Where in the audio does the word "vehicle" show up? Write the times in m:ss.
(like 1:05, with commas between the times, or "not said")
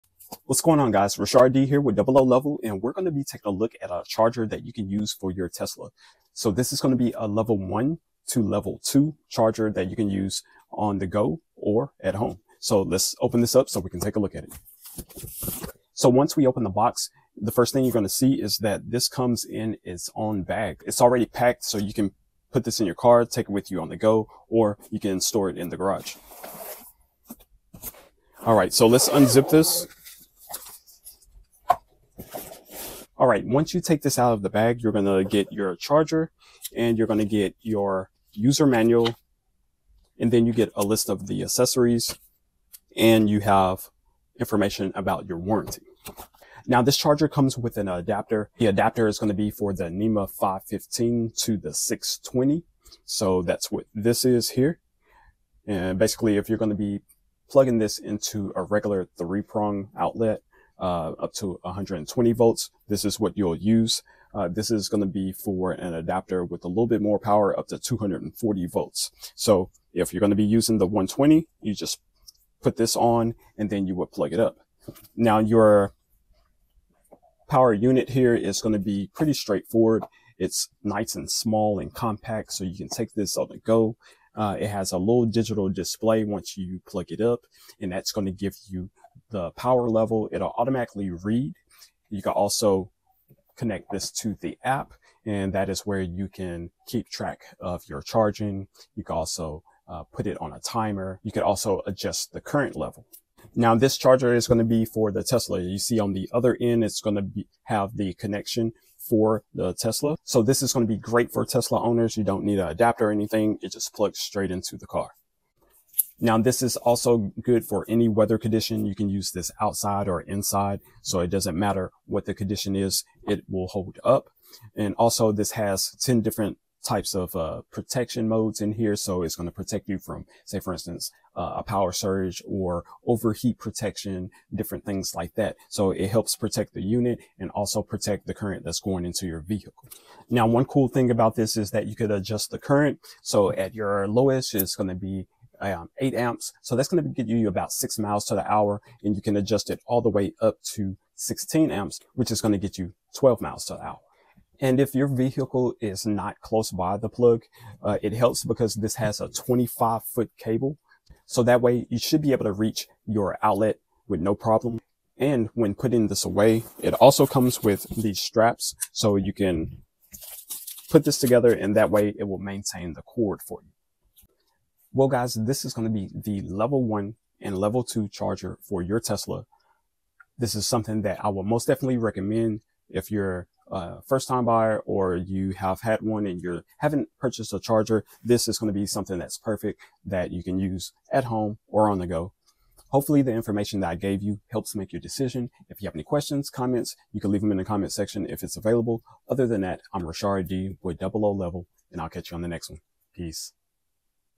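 2:19, 2:35.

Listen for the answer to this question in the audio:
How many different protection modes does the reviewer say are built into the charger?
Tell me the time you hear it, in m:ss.
2:05.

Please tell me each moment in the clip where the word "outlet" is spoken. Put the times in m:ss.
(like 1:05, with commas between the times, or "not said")
0:59, 2:43.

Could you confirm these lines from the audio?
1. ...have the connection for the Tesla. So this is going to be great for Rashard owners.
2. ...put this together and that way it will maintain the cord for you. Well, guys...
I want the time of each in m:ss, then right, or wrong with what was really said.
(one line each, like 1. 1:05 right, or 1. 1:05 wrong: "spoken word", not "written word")
1. 1:47 wrong: "Tesla", not "Rashard"
2. 2:50 right.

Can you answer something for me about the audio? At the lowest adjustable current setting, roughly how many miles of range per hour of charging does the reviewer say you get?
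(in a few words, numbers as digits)
6.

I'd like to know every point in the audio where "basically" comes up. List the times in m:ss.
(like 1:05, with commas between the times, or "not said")
0:55.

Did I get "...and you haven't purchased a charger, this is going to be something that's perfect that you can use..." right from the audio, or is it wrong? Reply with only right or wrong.
right.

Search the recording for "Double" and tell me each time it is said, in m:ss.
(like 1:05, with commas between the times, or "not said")
0:01, 3:20.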